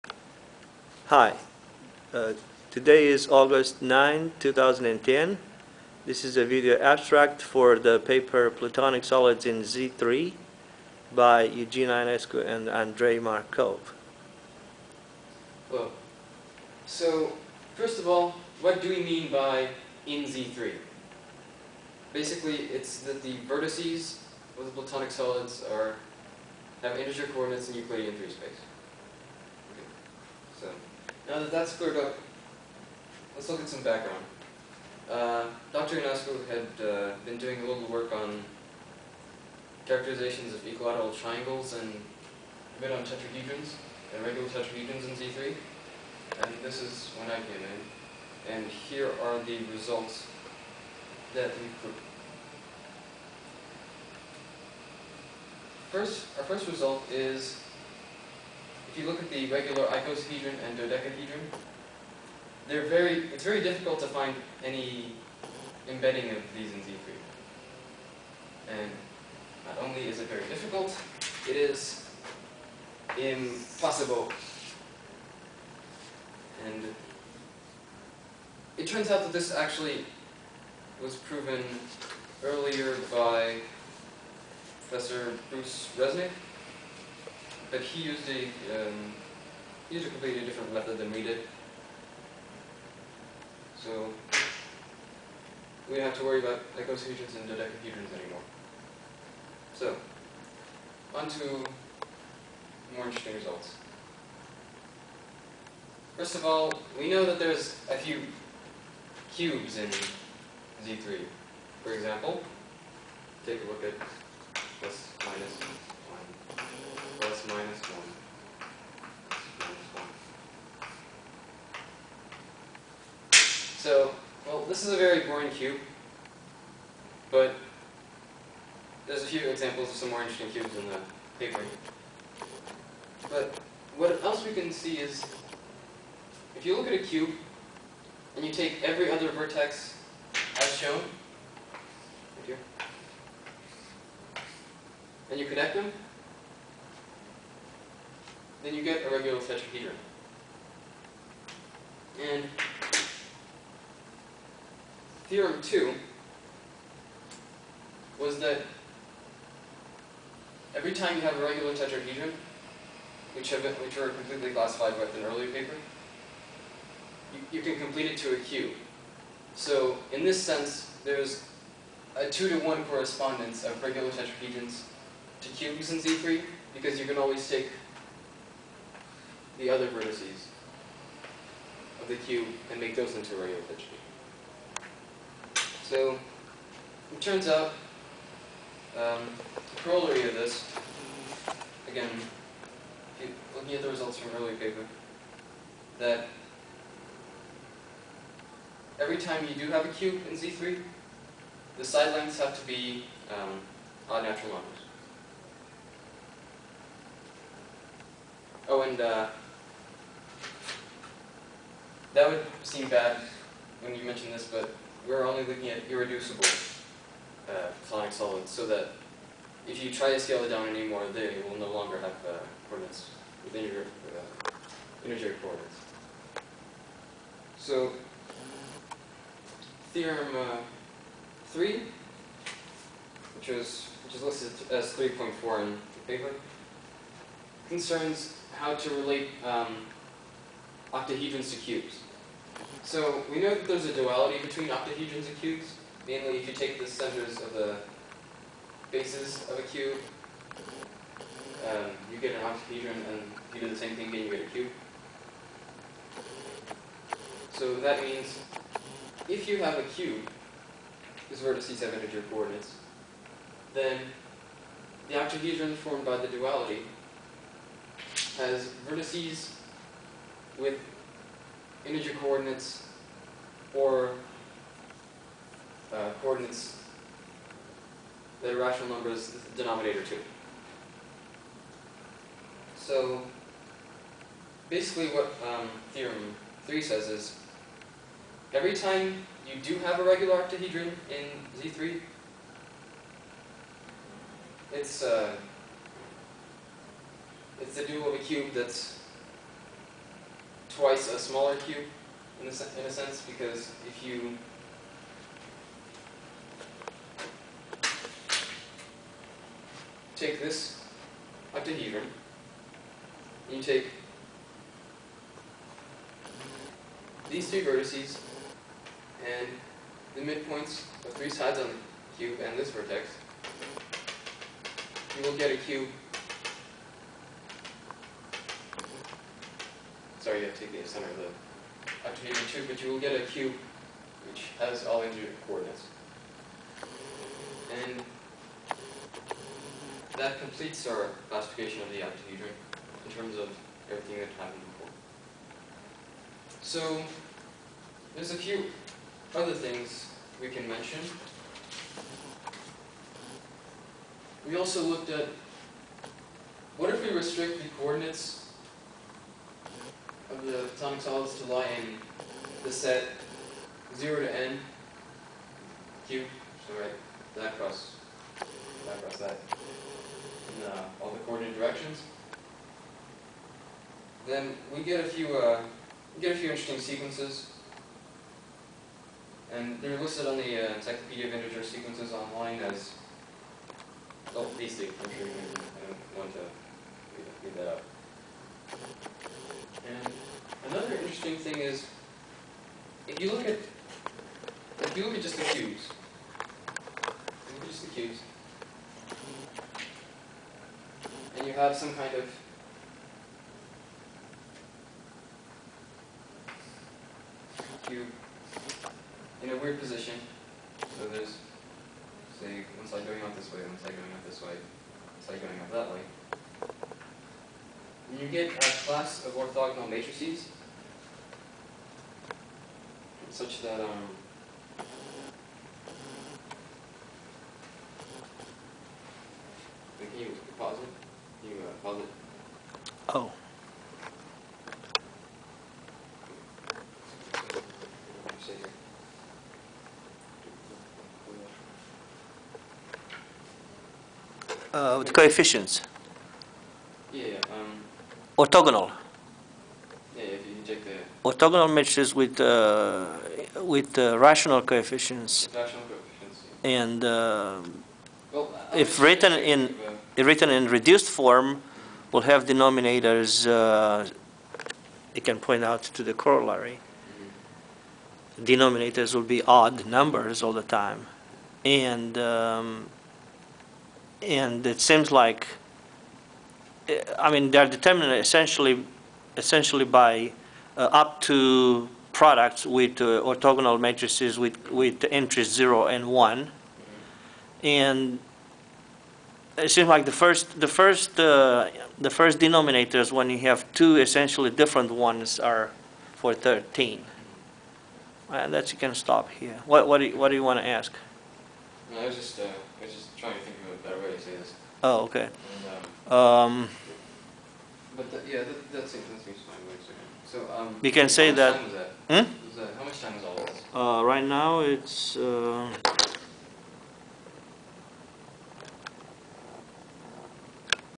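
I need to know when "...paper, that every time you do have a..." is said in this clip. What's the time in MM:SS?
03:14.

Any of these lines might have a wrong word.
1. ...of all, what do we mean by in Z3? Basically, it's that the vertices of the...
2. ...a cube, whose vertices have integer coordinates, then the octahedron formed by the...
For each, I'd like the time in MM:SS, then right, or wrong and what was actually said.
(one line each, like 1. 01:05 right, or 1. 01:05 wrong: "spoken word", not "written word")
1. 00:17 right
2. 04:19 right.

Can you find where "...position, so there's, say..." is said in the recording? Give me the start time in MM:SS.
06:49.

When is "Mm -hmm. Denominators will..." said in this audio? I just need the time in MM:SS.
07:46.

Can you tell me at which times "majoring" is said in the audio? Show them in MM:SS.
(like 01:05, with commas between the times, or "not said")
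not said.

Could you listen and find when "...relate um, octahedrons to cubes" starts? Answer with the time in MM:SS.
03:58.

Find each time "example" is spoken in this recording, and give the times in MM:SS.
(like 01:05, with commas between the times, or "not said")
01:51, 02:09.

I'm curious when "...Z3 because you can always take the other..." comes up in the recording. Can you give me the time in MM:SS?
02:55.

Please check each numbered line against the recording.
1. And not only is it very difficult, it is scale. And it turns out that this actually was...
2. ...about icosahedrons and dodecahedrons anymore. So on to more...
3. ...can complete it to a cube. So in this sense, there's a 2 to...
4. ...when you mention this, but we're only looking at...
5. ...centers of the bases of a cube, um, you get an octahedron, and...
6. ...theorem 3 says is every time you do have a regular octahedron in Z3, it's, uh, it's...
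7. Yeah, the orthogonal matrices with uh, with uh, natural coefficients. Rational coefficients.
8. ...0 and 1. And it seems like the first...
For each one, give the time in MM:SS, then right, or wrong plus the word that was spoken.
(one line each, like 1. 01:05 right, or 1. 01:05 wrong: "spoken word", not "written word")
1. 01:08 wrong: "impossible", not "scale"
2. 01:36 right
3. 02:47 right
4. 03:33 right
5. 04:06 right
6. 04:45 right
7. 07:30 wrong: "rational", not "natural"
8. 08:05 right.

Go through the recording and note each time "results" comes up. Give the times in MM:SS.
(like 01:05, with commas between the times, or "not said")
00:49, 00:56, 01:43, 03:13.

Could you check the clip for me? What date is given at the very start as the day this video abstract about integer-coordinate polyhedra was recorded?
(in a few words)
August 9, 2010.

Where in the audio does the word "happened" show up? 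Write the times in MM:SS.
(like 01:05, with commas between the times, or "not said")
05:44.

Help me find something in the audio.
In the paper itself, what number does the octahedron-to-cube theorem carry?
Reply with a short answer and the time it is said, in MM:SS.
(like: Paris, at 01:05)
3.4, at 03:54.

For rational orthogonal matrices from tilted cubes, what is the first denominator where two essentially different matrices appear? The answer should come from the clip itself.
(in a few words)
13.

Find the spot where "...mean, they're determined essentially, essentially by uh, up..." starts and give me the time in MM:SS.
07:57.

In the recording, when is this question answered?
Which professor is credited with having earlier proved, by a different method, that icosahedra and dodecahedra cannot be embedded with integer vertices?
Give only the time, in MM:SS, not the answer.
01:25.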